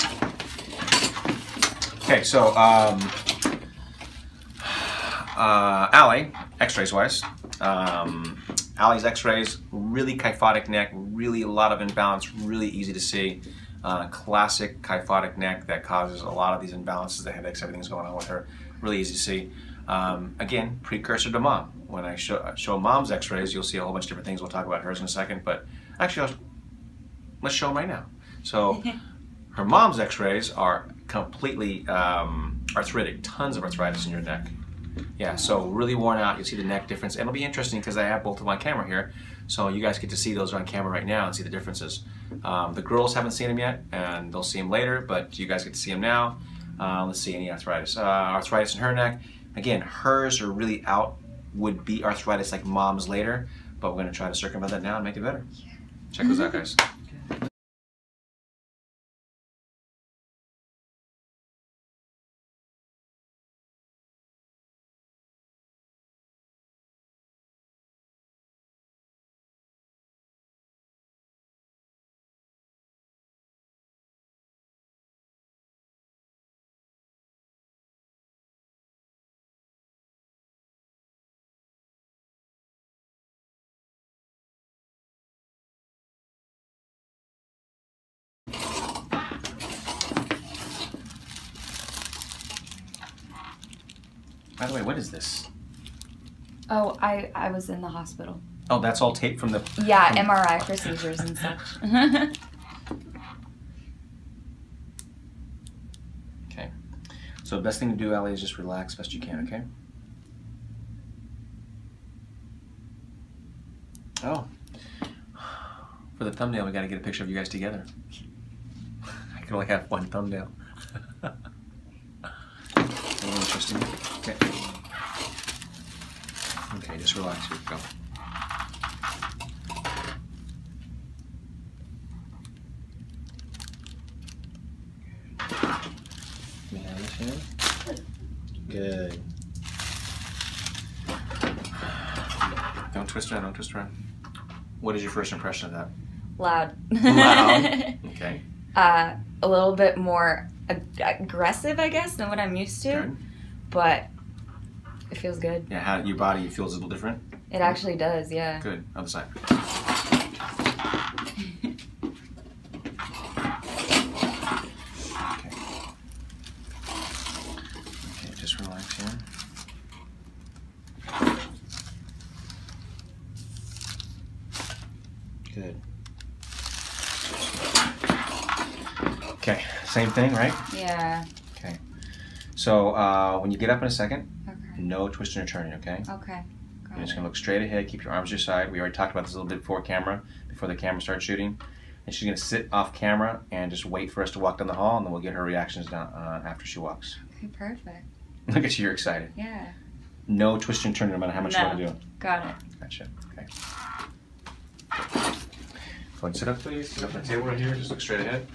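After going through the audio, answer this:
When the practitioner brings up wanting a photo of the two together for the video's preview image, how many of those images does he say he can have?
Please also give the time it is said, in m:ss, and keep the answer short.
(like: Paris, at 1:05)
1, at 1:59.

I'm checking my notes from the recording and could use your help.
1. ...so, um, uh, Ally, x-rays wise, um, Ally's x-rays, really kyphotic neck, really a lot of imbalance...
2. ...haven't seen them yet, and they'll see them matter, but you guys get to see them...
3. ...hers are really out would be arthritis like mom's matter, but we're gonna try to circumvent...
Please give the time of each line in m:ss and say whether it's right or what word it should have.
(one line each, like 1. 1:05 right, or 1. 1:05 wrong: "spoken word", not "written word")
1. 0:02 right
2. 0:43 wrong: "later", not "matter"
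3. 0:49 wrong: "later", not "matter".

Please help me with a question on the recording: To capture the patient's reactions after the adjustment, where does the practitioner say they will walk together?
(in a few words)
down the hall.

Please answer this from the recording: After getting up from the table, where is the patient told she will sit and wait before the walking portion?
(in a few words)
off camera.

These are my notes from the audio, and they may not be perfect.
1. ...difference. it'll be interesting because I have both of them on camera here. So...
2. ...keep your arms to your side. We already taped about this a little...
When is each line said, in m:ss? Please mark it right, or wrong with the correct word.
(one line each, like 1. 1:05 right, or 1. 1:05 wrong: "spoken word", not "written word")
1. 0:36 right
2. 3:07 wrong: "talked", not "taped".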